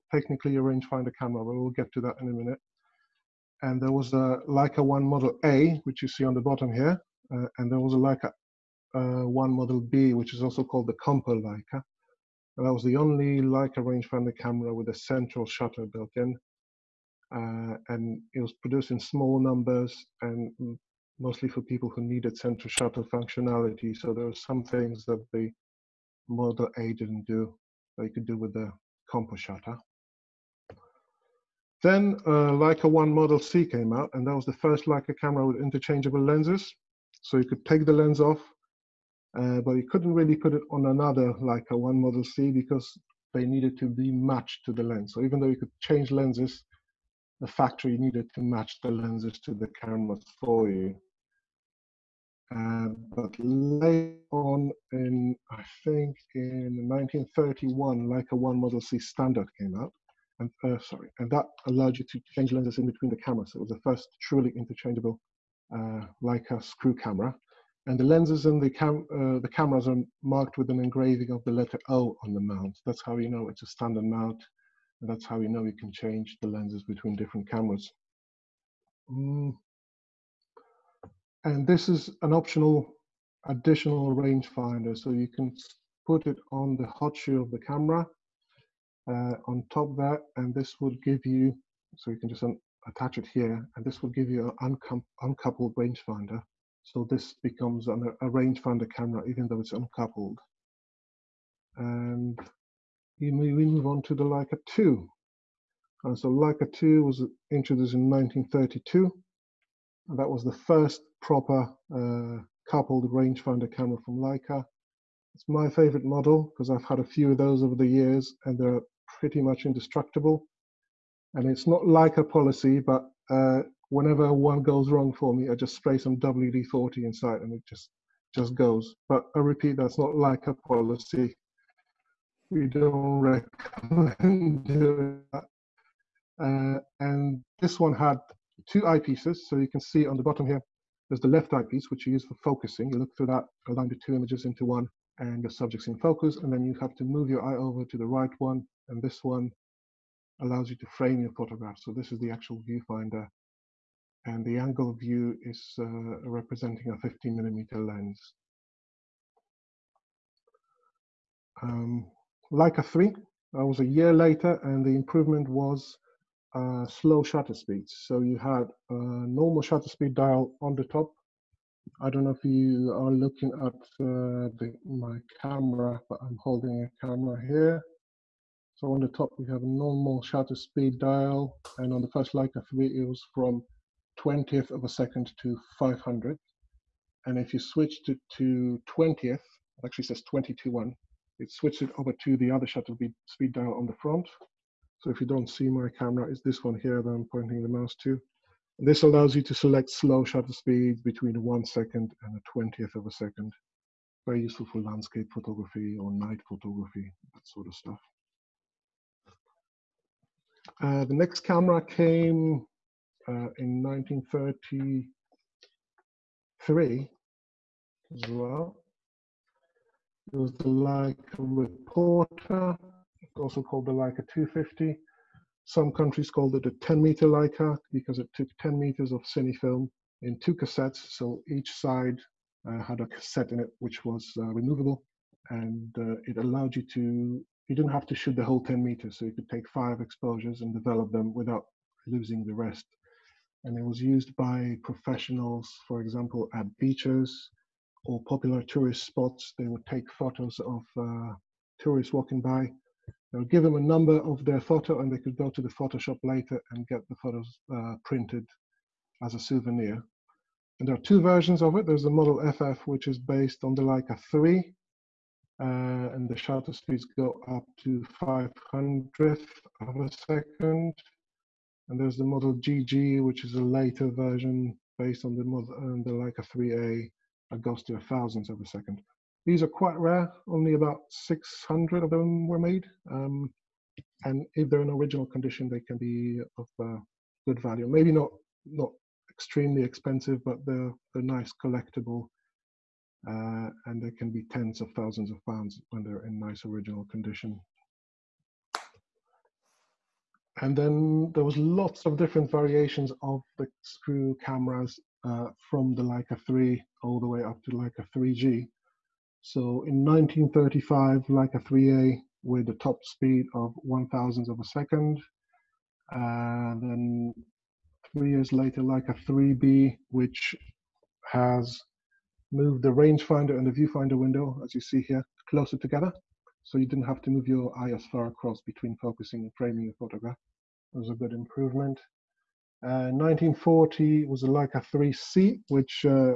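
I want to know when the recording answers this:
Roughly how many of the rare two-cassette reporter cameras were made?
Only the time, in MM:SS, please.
04:41.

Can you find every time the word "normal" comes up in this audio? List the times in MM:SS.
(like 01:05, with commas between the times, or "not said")
02:48, 02:59.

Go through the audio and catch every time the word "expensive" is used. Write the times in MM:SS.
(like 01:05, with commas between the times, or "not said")
04:49.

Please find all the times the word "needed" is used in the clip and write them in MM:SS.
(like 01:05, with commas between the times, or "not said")
00:22, 00:43, 00:47.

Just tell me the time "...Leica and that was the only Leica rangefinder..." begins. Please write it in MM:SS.
00:11.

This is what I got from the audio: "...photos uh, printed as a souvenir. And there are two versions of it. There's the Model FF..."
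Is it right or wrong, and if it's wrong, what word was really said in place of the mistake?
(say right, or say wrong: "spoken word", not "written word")
right.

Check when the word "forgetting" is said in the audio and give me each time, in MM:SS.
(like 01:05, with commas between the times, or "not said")
not said.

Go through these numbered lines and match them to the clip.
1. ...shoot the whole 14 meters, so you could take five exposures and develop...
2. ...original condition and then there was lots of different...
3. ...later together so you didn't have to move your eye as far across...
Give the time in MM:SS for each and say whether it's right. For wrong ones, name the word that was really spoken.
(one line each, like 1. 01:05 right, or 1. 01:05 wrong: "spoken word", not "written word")
1. 03:58 wrong: "10", not "14"
2. 04:56 right
3. 05:25 wrong: "closer", not "later".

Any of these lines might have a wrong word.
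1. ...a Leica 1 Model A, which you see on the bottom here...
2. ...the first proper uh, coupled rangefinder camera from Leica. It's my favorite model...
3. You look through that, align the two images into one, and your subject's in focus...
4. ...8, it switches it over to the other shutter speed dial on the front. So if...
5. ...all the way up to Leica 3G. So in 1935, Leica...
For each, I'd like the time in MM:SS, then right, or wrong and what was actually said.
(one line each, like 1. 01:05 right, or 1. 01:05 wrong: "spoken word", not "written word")
1. 00:04 right
2. 01:50 right
3. 02:22 right
4. 03:10 wrong: "1", not "8"
5. 05:07 right.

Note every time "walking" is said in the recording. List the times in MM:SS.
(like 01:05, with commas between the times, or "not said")
04:12.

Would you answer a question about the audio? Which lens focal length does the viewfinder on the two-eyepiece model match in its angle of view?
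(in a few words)
15 millimeter.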